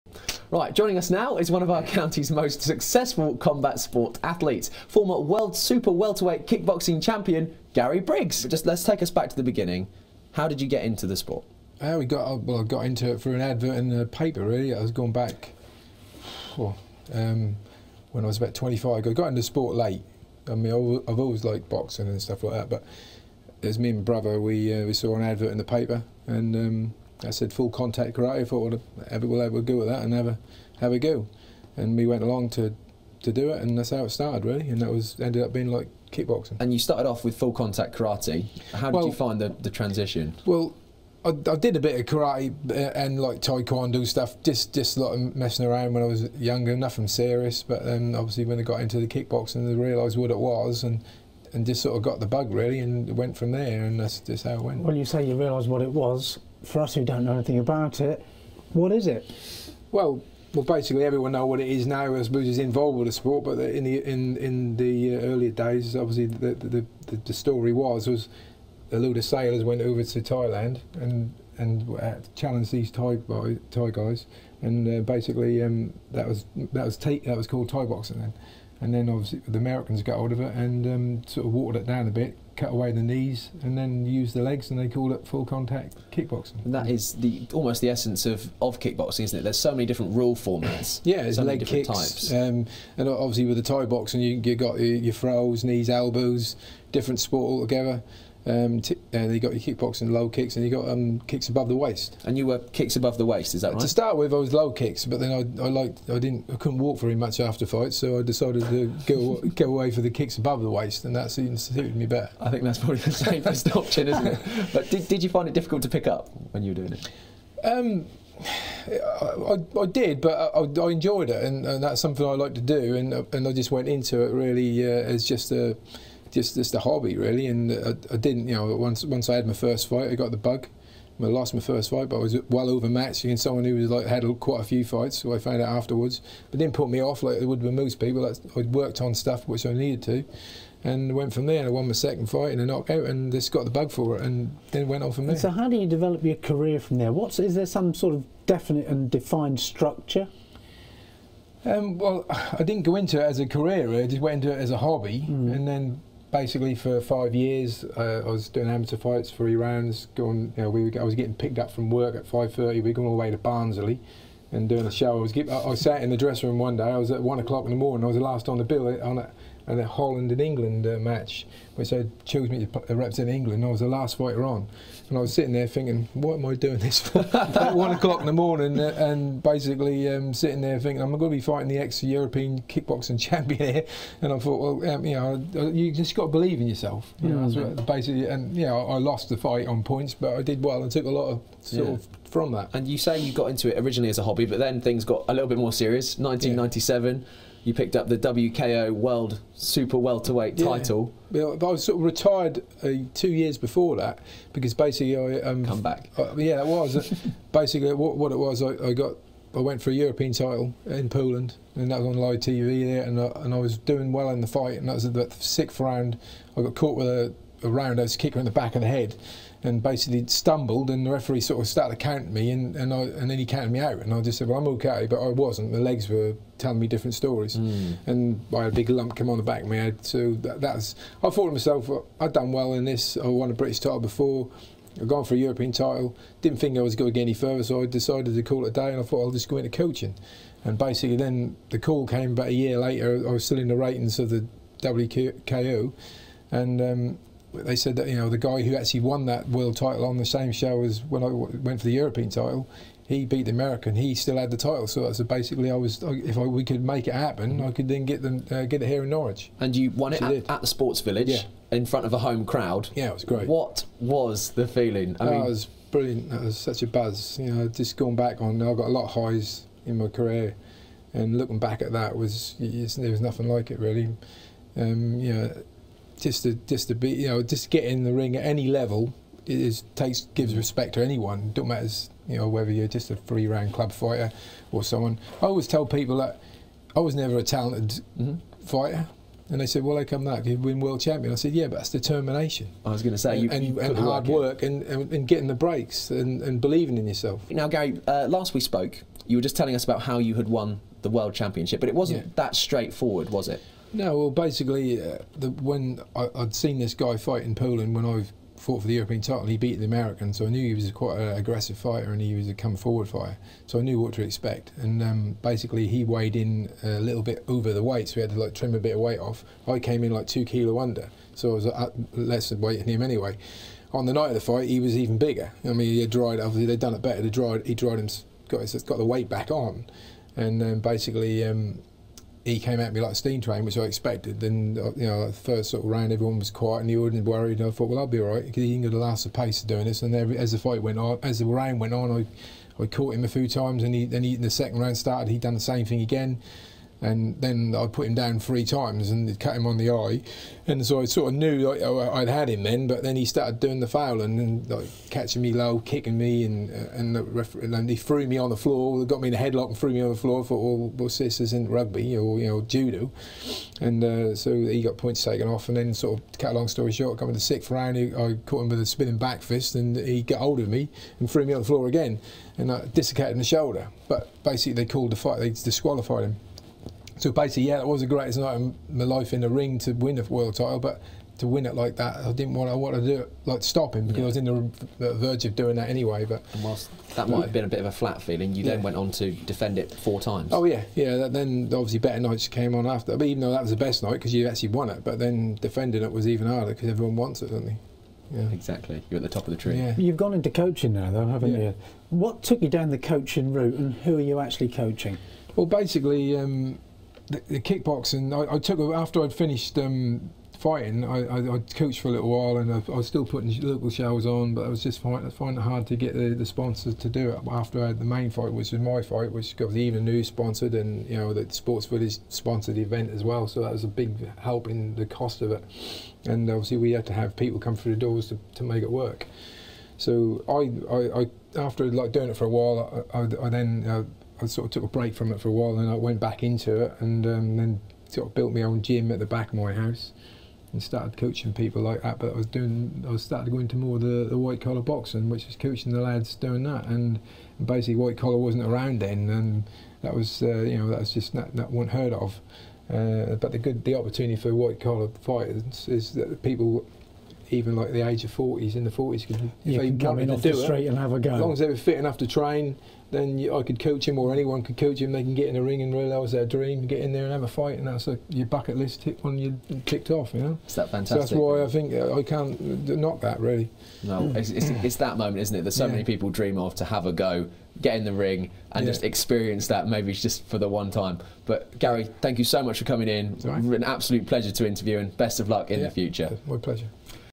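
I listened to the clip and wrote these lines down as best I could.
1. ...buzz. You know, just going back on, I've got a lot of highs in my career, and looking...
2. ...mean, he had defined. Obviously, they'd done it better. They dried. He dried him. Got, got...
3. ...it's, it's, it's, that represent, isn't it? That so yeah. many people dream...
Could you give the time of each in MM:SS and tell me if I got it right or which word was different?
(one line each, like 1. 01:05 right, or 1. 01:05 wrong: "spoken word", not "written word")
1. 04:26 right
2. 05:25 wrong: "dried", not "defined"
3. 07:54 wrong: "moment", not "represent".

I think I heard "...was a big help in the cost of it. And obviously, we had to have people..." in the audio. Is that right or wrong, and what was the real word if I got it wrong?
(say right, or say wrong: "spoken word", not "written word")
right.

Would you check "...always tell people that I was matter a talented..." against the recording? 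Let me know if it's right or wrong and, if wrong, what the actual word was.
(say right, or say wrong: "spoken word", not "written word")
wrong: "never", not "matter".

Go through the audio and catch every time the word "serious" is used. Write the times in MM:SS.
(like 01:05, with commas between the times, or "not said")
00:47, 03:15.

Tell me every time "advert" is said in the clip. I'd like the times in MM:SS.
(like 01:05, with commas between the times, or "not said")
00:13, 00:25.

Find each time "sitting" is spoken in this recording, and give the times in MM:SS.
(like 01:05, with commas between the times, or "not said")
02:55, 03:00.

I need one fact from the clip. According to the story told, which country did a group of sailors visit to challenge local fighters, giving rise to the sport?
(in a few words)
Thailand.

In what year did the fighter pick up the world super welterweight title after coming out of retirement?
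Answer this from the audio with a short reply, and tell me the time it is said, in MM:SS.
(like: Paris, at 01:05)
1997, at 03:16.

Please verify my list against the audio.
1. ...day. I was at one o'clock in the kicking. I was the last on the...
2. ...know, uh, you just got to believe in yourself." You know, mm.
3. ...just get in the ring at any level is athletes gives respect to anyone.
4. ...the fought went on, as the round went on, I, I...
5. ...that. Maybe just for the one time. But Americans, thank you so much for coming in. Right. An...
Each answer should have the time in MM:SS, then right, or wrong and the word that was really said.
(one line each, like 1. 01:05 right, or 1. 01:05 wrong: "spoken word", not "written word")
1. 02:46 wrong: "morning", not "kicking"
2. 03:05 right
3. 04:37 wrong: "takes", not "athletes"
4. 05:40 wrong: "fight", not "fought"
5. 07:59 wrong: "Gary", not "Americans".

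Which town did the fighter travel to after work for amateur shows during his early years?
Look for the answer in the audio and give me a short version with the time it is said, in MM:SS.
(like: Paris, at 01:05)
Barnsley, at 02:43.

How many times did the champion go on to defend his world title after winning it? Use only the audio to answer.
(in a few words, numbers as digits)
4.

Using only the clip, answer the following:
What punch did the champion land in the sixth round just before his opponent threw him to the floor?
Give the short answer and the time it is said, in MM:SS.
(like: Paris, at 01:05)
Spinning back fist, at 06:08.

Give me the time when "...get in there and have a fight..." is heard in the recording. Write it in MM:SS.
07:46.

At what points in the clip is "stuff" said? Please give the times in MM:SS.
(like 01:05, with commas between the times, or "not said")
00:22, 00:44, 02:19.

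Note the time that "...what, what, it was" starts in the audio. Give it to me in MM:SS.
03:27.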